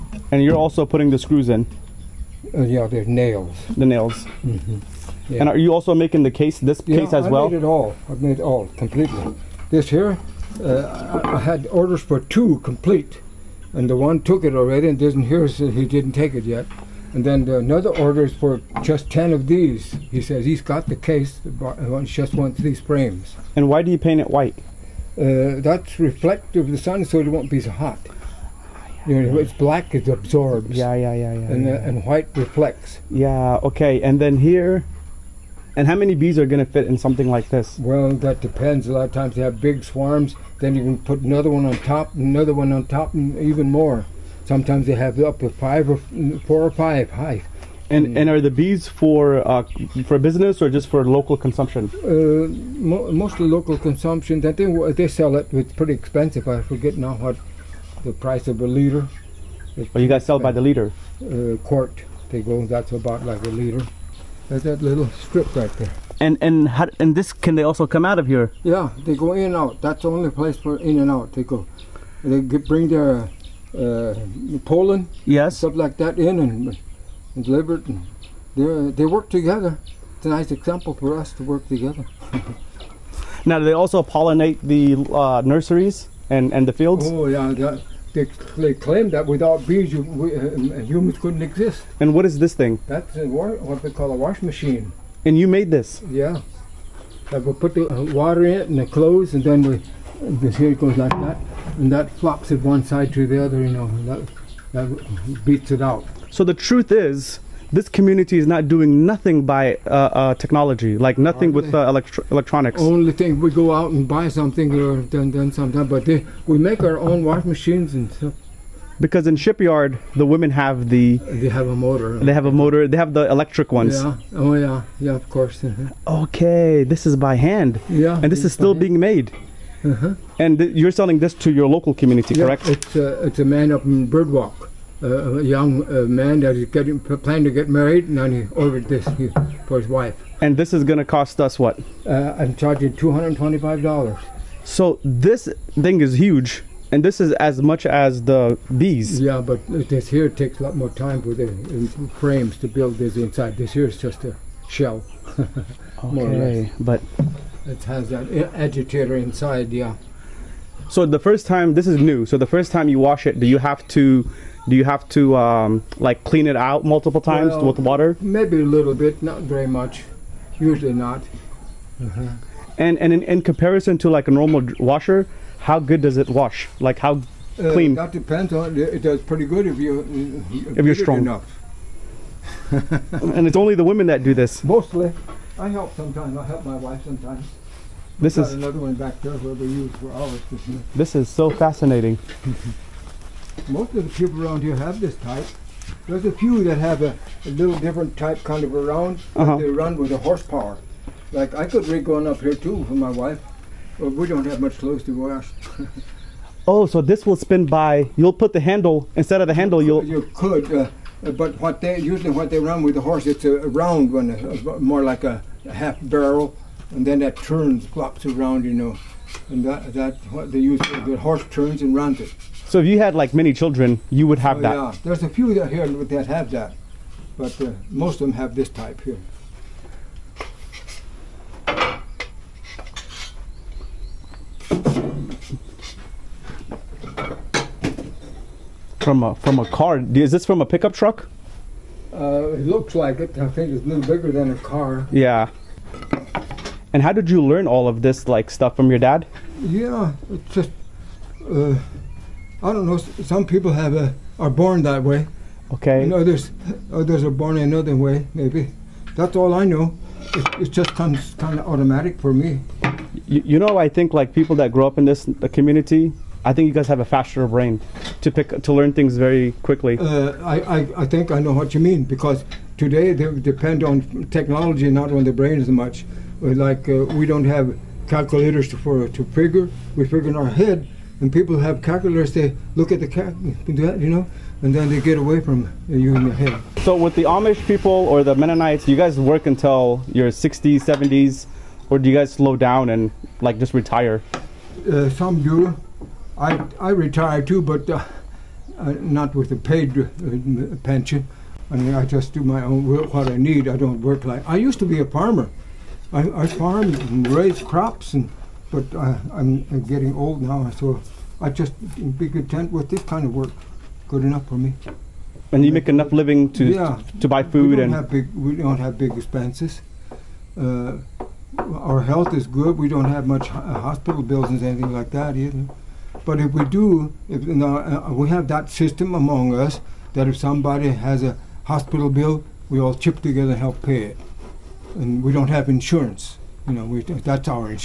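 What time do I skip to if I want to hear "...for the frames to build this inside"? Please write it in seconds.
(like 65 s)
151 s.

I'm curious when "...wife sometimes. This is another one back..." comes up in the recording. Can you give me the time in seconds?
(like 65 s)
186 s.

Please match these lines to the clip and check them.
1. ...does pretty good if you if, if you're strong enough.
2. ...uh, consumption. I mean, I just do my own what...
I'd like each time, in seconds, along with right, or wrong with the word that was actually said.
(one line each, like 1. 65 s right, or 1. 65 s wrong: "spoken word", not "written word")
1. 179 s right
2. 299 s wrong: "pension", not "consumption".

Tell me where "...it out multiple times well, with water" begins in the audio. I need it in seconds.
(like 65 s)
166 s.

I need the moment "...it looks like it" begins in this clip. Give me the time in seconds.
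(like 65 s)
242 s.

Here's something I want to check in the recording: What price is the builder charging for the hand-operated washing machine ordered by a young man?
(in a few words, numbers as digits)
$225.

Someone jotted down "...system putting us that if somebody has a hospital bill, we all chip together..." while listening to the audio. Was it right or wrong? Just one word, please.
wrong.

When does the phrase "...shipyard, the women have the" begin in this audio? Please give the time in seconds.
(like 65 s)
119 s.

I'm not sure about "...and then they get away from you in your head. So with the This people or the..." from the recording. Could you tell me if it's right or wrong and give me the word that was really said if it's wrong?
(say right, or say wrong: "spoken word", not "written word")
wrong: "Amish", not "This".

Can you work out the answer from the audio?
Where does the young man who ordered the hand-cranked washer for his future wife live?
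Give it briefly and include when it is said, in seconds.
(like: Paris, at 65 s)
Birdwalk, at 134 s.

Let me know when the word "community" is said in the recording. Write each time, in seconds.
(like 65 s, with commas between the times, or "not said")
107 s, 131 s, 265 s.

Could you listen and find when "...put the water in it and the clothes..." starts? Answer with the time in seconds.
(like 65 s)
97 s.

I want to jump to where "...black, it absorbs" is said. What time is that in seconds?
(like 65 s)
29 s.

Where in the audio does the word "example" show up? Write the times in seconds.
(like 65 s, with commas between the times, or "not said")
80 s.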